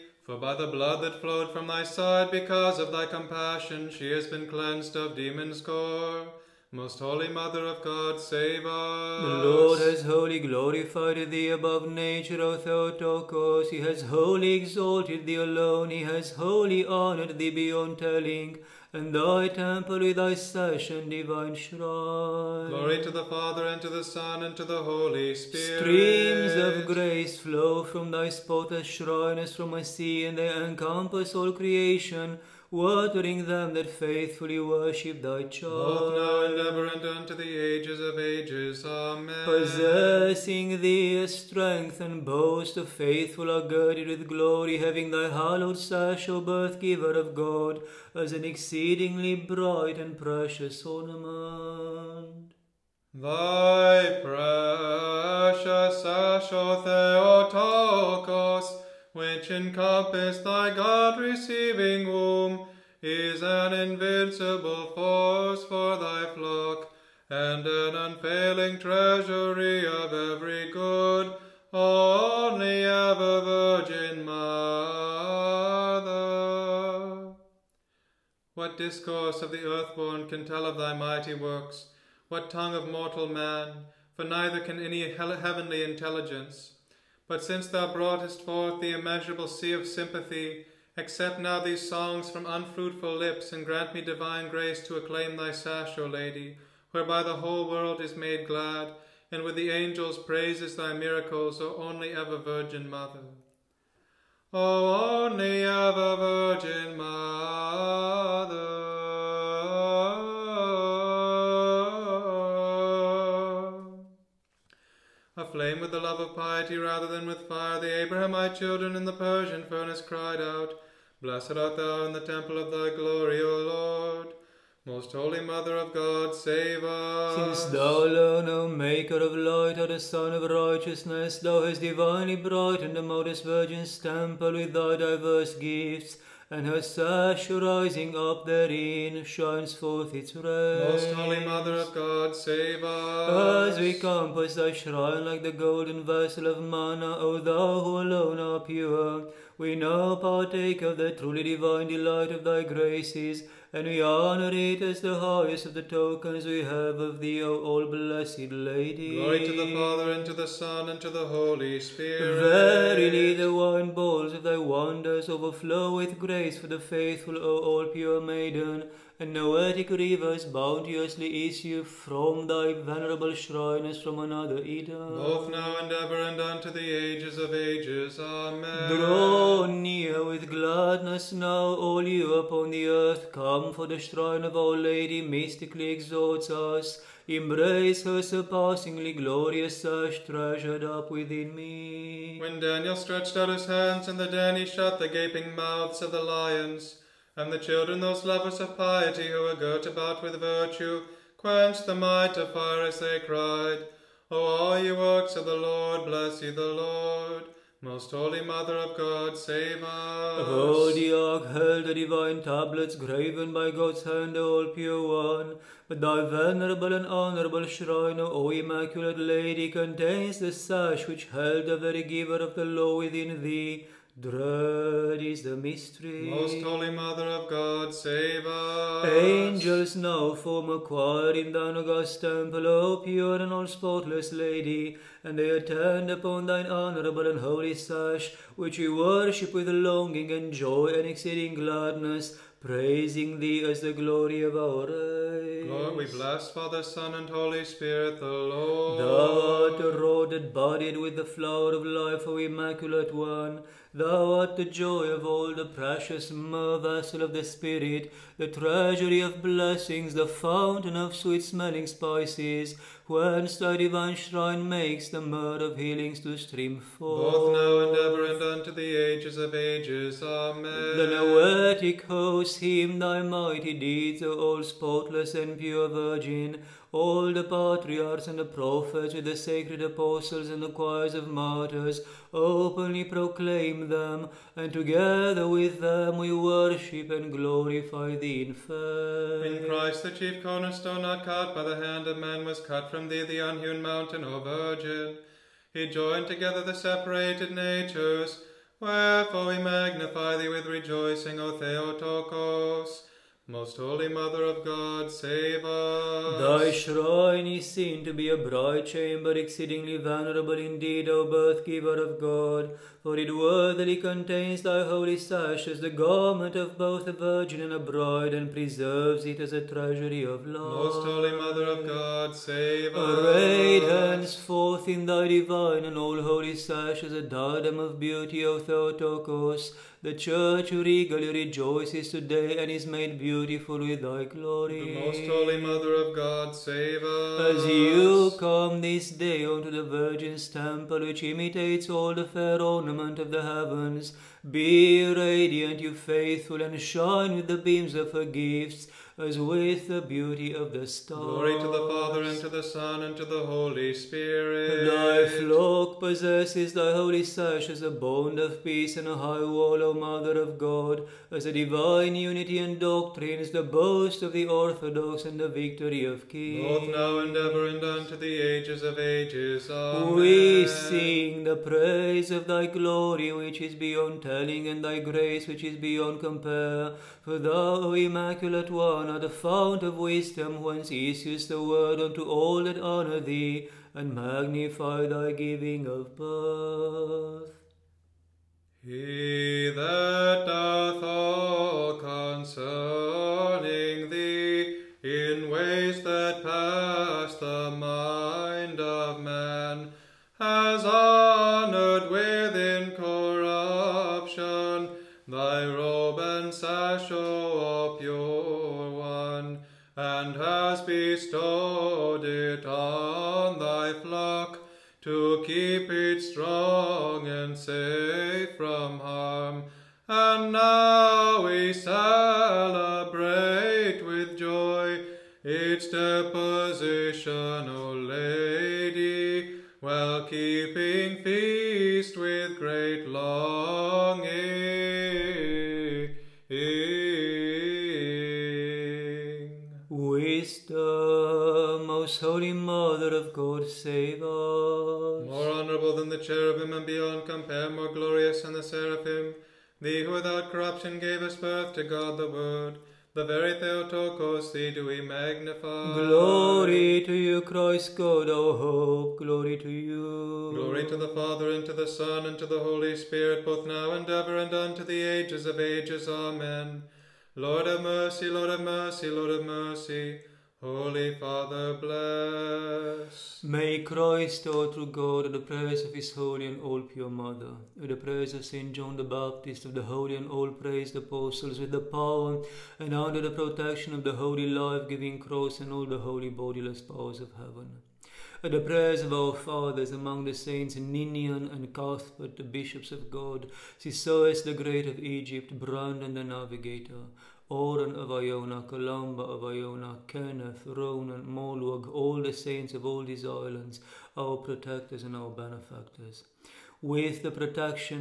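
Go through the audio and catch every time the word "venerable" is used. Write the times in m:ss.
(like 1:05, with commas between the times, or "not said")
2:52, 3:36, 5:09.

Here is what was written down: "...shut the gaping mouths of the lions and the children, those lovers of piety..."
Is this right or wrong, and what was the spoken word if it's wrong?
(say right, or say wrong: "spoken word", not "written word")
right.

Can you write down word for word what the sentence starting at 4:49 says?
In Christ the chief cornerstone not cut by the hand of man was cut from thee the unhewn mountain, O Virgin.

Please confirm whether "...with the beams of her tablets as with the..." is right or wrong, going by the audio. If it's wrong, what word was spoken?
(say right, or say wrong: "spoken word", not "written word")
wrong: "gifts", not "tablets".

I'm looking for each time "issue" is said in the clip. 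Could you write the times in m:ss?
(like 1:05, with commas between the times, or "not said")
2:51, 6:20.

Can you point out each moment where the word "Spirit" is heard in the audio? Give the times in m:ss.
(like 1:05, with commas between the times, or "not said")
0:25, 2:41, 4:07, 4:17, 5:53, 7:42.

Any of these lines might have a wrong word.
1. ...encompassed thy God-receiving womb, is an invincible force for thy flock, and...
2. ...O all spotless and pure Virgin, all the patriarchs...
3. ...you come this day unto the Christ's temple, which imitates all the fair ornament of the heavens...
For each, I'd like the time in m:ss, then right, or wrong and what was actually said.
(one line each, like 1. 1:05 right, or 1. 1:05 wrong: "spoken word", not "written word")
1. 0:59 right
2. 4:34 right
3. 5:37 wrong: "Virgin", not "Christ".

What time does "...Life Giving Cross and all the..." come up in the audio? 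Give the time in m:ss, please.
8:04.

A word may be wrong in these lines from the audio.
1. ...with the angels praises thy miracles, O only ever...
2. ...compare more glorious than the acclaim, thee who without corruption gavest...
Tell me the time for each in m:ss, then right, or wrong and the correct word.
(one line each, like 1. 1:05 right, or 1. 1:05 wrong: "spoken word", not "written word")
1. 1:39 right
2. 7:27 wrong: "seraphim", not "acclaim".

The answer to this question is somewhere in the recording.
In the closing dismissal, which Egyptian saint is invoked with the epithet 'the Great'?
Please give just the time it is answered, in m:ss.
8:13.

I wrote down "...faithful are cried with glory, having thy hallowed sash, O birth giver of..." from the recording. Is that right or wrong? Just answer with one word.
wrong.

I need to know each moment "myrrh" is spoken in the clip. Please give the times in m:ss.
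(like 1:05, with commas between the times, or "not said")
4:16, 4:25.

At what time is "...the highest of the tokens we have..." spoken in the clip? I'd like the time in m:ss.
2:35.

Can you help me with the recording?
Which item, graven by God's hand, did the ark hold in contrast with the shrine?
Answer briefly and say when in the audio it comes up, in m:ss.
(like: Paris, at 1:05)
divine tablets, at 3:31.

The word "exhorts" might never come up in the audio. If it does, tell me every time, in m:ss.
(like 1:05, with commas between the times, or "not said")
3:05.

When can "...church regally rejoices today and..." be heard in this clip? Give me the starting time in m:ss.
5:30.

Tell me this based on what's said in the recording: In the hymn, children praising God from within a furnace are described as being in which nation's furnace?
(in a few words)
Persian.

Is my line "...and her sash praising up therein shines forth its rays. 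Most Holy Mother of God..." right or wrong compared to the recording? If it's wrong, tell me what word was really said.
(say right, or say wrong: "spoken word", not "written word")
wrong: "rising", not "praising".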